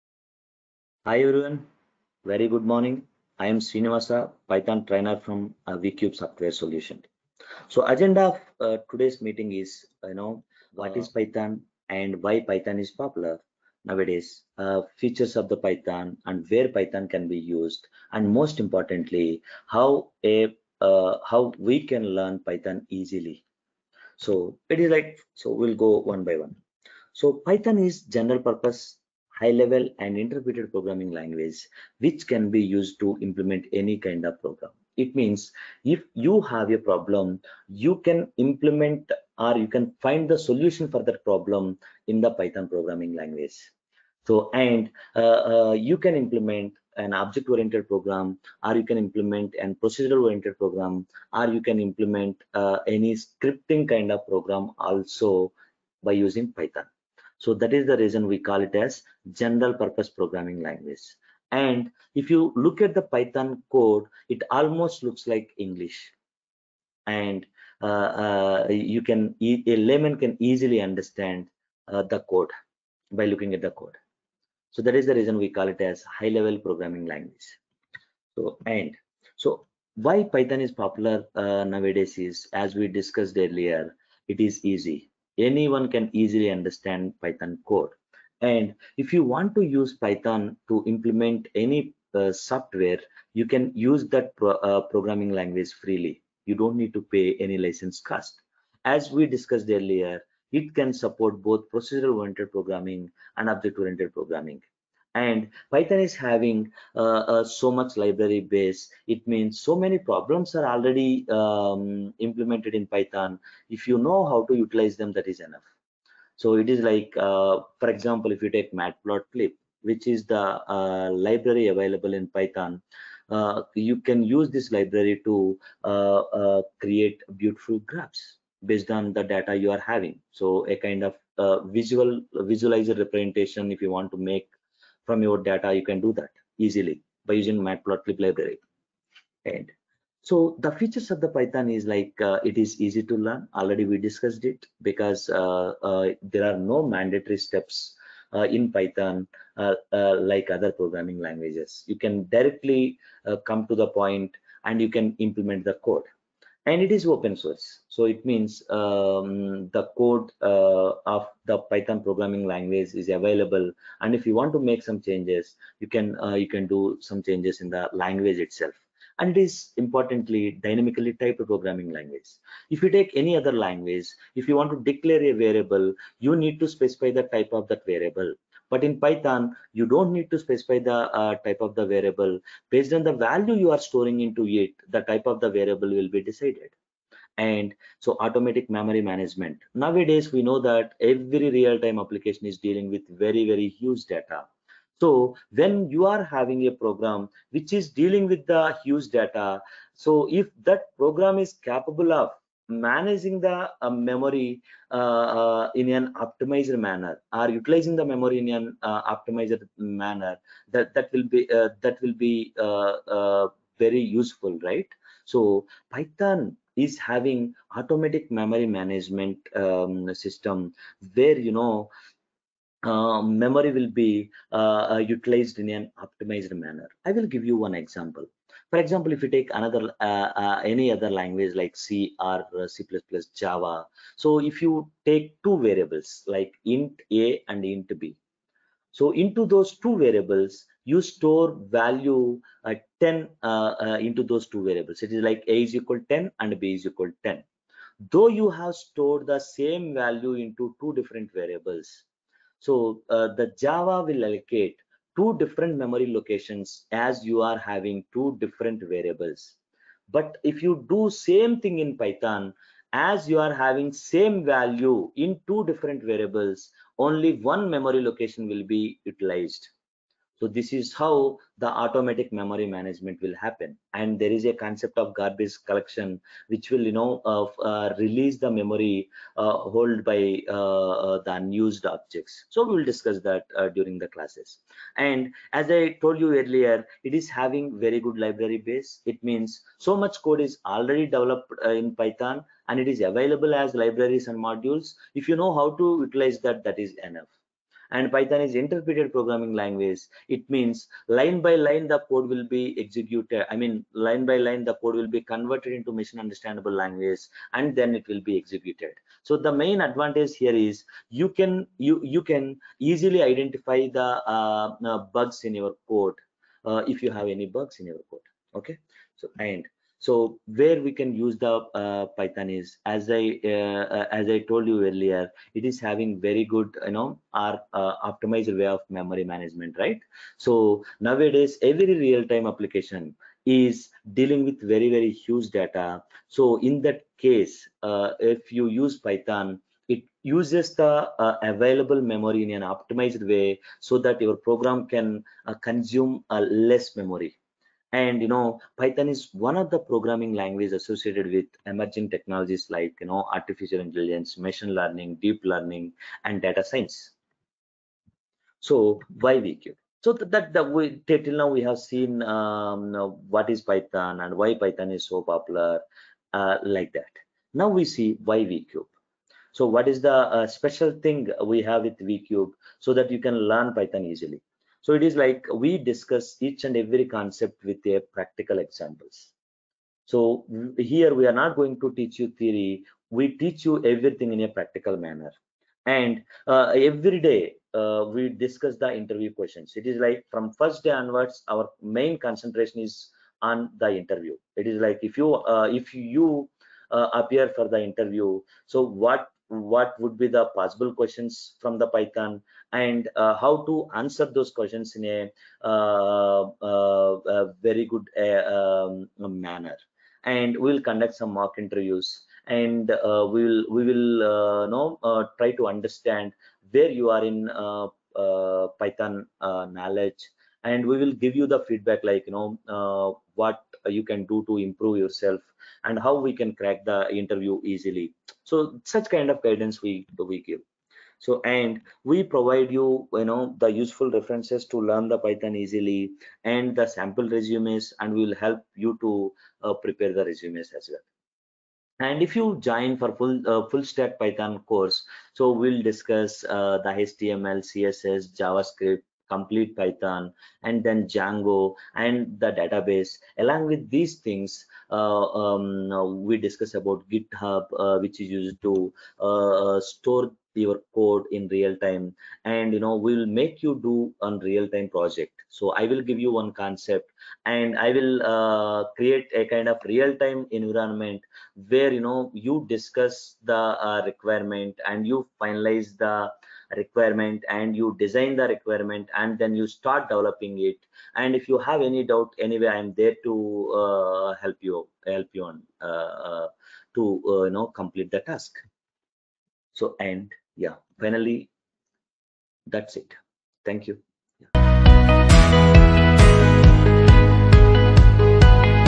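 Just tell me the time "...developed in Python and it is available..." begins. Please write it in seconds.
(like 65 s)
291 s.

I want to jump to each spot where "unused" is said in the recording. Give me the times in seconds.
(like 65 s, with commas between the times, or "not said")
281 s.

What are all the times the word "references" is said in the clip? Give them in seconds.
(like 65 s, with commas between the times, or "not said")
434 s.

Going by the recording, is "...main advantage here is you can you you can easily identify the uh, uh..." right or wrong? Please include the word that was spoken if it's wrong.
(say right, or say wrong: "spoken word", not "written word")
right.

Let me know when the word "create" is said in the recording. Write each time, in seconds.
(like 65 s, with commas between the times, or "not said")
126 s, 468 s.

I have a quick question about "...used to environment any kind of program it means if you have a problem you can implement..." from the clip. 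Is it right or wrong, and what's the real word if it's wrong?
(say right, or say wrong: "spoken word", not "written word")
wrong: "implement", not "environment".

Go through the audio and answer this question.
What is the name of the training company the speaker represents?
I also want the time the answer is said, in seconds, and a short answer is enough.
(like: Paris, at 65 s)
VCube Software Solution, at 5 s.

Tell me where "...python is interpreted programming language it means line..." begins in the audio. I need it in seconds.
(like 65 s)
298 s.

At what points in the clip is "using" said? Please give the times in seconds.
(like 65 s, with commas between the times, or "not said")
56 s, 137 s.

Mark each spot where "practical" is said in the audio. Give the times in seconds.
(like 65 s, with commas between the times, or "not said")
378 s, 384 s.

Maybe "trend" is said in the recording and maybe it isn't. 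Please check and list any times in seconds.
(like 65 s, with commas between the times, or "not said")
not said.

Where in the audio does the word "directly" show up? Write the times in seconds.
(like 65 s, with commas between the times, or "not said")
152 s.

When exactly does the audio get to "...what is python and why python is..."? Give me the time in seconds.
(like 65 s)
363 s.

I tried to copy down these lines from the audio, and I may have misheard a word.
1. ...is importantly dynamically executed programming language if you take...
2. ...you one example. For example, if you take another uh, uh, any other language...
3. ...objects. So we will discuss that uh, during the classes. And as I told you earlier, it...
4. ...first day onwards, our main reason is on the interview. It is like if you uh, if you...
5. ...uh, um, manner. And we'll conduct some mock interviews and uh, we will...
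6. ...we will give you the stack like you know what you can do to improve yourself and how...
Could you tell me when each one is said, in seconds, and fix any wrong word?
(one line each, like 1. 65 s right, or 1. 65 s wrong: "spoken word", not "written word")
1. 169 s wrong: "typed", not "executed"
2. 227 s right
3. 281 s right
4. 390 s wrong: "concentration", not "reason"
5. 408 s right
6. 420 s wrong: "feedback", not "stack".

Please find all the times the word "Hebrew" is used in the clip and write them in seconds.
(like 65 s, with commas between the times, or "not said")
not said.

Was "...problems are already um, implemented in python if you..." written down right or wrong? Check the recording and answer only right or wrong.
right.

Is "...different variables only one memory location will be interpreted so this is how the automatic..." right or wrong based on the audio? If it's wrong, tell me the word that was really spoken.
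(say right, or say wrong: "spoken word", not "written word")
wrong: "utilized", not "interpreted".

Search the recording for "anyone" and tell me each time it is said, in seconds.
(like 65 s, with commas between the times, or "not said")
85 s.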